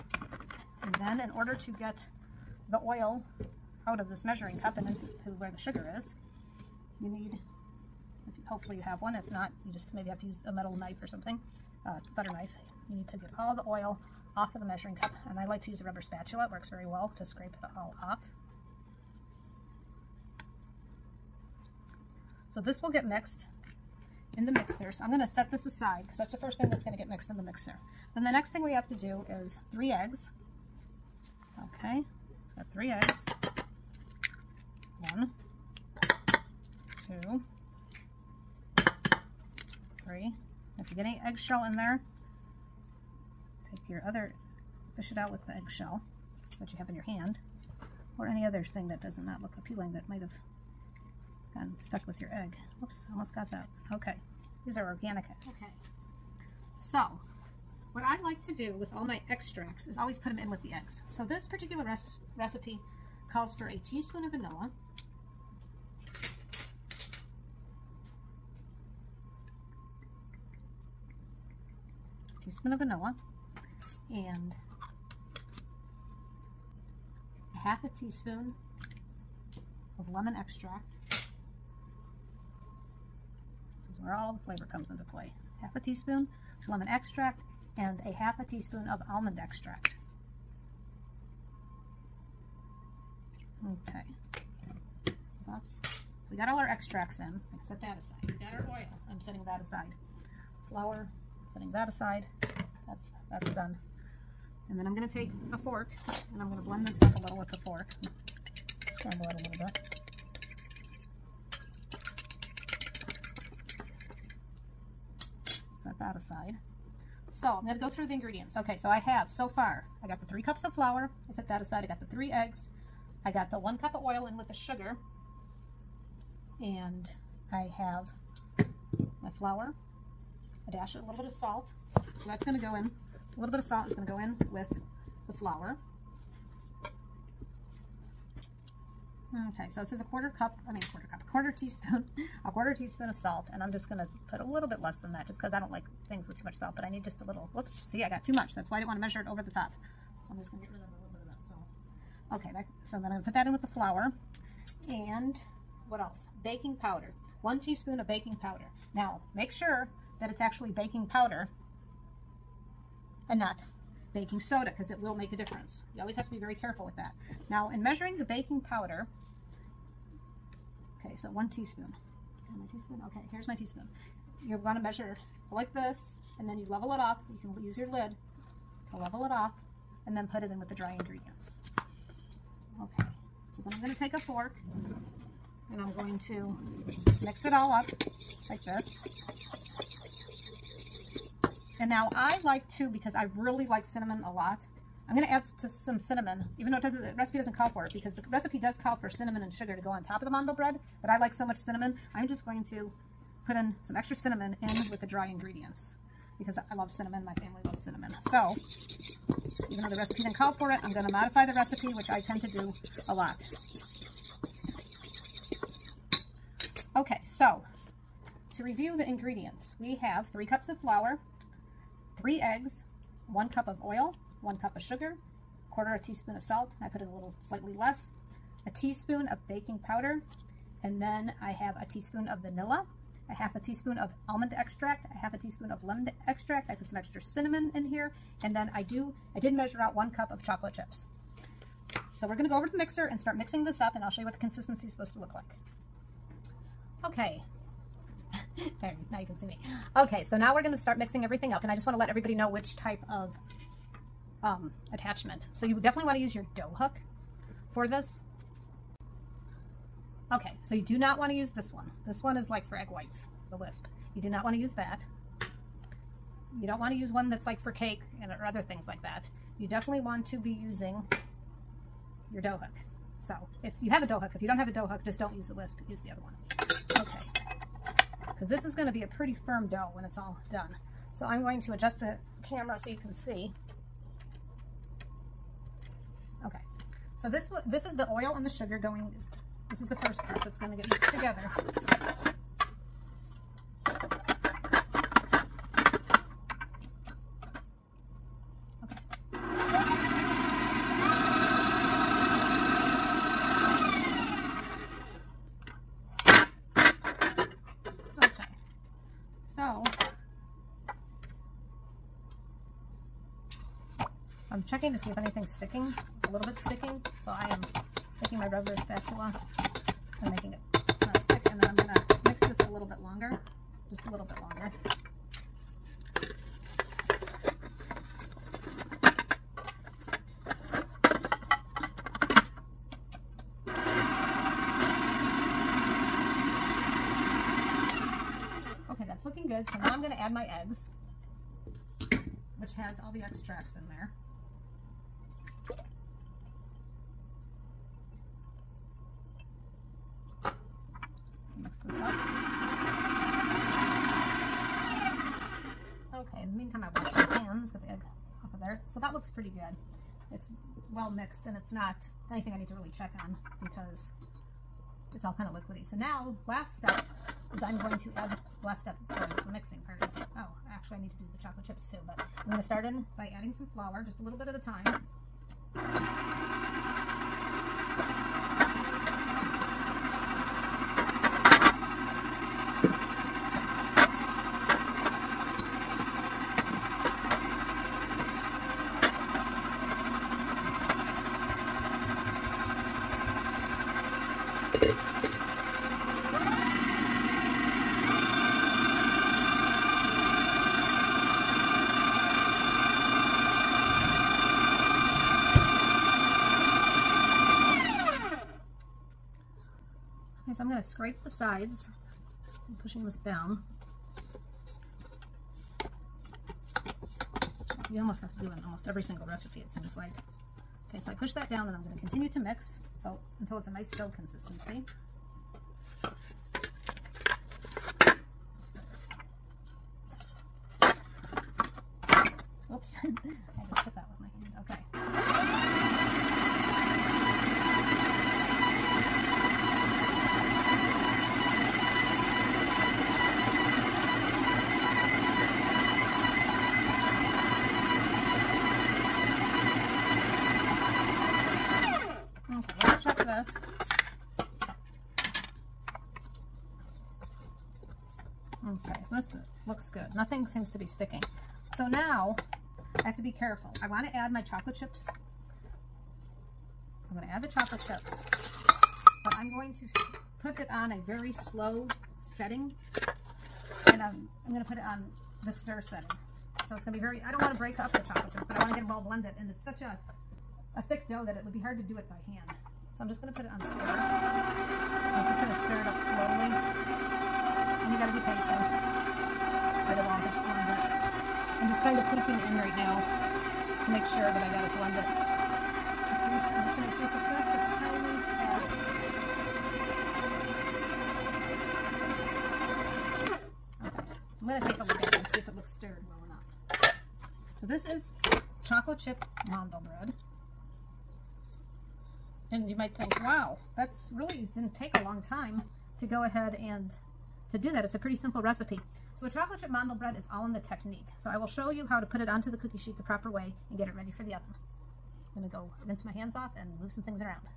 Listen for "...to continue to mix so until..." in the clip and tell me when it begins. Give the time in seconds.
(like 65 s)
421 s.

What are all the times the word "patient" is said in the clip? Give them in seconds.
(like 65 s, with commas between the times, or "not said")
488 s.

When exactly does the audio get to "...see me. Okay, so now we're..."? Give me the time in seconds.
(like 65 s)
249 s.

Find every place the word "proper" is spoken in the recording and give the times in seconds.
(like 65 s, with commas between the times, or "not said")
523 s.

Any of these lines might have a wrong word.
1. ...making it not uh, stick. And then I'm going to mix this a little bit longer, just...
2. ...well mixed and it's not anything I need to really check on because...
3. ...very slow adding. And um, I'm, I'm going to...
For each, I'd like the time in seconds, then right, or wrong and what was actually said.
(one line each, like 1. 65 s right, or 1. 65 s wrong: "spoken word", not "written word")
1. 320 s right
2. 360 s right
3. 471 s wrong: "setting", not "adding".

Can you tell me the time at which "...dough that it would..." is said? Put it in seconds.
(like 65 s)
481 s.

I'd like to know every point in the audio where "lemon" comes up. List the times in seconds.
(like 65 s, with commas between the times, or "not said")
80 s, 86 s, 235 s.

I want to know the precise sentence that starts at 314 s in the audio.
checking to see if anything's sticking, a little bit sticking.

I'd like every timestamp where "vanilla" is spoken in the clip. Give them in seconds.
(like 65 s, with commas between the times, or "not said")
64 s, 72 s, 232 s.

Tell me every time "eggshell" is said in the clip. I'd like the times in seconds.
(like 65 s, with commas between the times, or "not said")
41 s, 45 s.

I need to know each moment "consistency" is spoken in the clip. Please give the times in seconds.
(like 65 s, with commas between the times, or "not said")
244 s, 424 s.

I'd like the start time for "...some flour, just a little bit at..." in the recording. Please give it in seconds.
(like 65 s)
373 s.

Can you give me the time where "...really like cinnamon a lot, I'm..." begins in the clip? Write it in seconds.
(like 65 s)
193 s.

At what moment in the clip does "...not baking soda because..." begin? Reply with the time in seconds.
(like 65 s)
163 s.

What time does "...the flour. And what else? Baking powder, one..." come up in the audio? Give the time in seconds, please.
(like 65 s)
153 s.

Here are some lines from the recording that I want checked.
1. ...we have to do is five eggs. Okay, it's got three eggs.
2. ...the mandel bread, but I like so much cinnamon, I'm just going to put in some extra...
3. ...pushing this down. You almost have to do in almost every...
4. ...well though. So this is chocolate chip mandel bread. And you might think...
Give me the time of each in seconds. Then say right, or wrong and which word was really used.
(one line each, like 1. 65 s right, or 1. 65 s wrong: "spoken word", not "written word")
1. 28 s wrong: "three", not "five"
2. 200 s right
3. 412 s right
4. 506 s wrong: "enough", not "though".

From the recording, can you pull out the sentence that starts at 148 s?
That's why I didn't want to measure it over the top.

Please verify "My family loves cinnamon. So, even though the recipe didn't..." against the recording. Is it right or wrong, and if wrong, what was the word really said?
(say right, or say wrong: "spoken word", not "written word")
right.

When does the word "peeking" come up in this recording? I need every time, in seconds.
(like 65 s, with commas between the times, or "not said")
492 s.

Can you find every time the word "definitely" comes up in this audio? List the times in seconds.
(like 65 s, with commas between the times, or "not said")
255 s, 269 s.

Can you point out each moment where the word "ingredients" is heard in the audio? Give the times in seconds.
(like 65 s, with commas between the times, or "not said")
118 s, 180 s, 205 s, 219 s.